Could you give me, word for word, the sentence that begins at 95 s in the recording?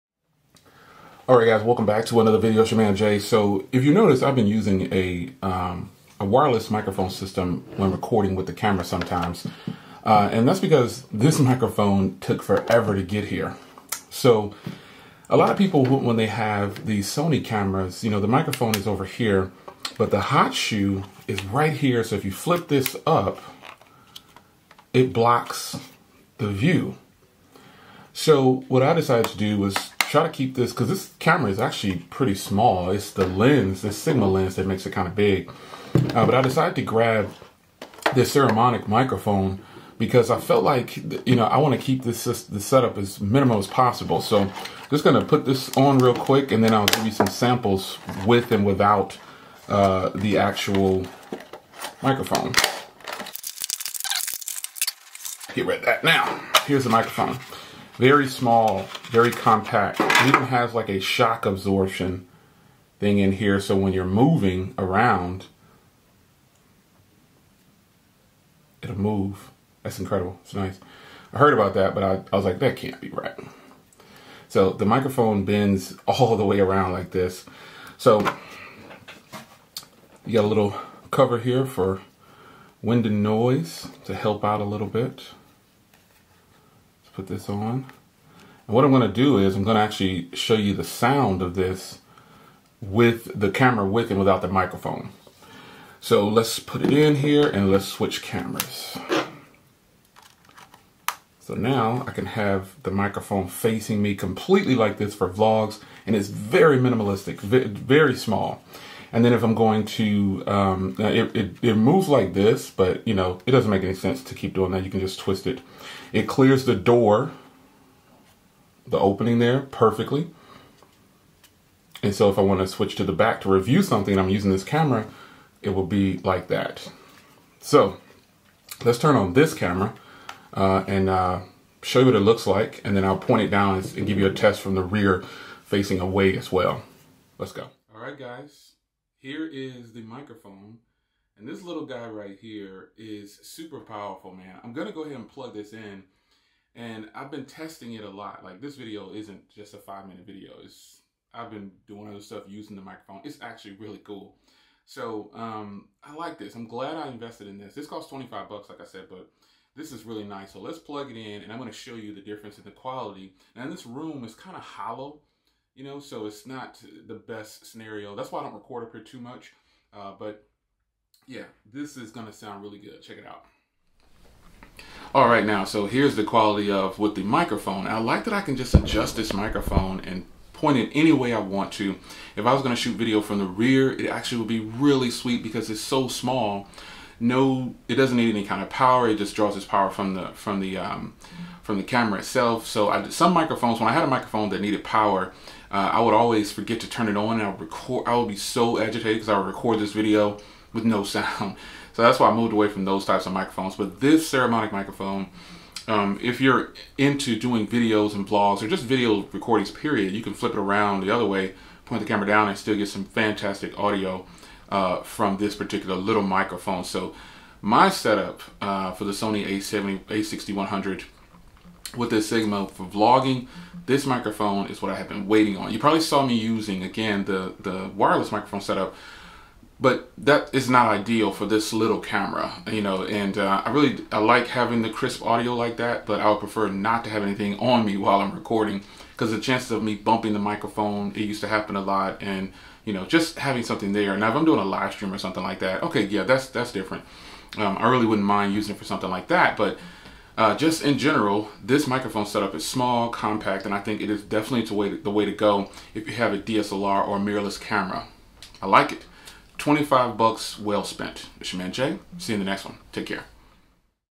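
So let's put it in here and let's switch cameras.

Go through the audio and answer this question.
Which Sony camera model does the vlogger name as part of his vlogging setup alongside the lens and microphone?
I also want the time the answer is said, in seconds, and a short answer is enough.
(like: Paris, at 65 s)
A6100, at 220 s.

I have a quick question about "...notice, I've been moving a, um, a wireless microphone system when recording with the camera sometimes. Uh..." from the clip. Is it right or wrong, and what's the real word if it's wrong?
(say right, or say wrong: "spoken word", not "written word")
wrong: "using", not "moving".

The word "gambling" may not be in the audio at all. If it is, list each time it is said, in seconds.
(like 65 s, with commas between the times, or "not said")
not said.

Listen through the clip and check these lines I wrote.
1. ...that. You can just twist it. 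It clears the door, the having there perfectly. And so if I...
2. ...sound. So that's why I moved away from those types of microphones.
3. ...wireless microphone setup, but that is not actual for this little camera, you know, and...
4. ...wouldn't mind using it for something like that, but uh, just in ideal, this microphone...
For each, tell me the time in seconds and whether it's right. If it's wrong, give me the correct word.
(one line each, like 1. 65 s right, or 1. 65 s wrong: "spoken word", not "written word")
1. 114 s wrong: "opening", not "having"
2. 201 s right
3. 227 s wrong: "ideal", not "actual"
4. 248 s wrong: "general", not "ideal".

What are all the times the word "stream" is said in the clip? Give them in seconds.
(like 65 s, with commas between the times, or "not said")
244 s.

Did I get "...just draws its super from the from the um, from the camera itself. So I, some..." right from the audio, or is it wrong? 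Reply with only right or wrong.
wrong.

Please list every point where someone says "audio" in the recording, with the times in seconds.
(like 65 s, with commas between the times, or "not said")
213 s, 235 s.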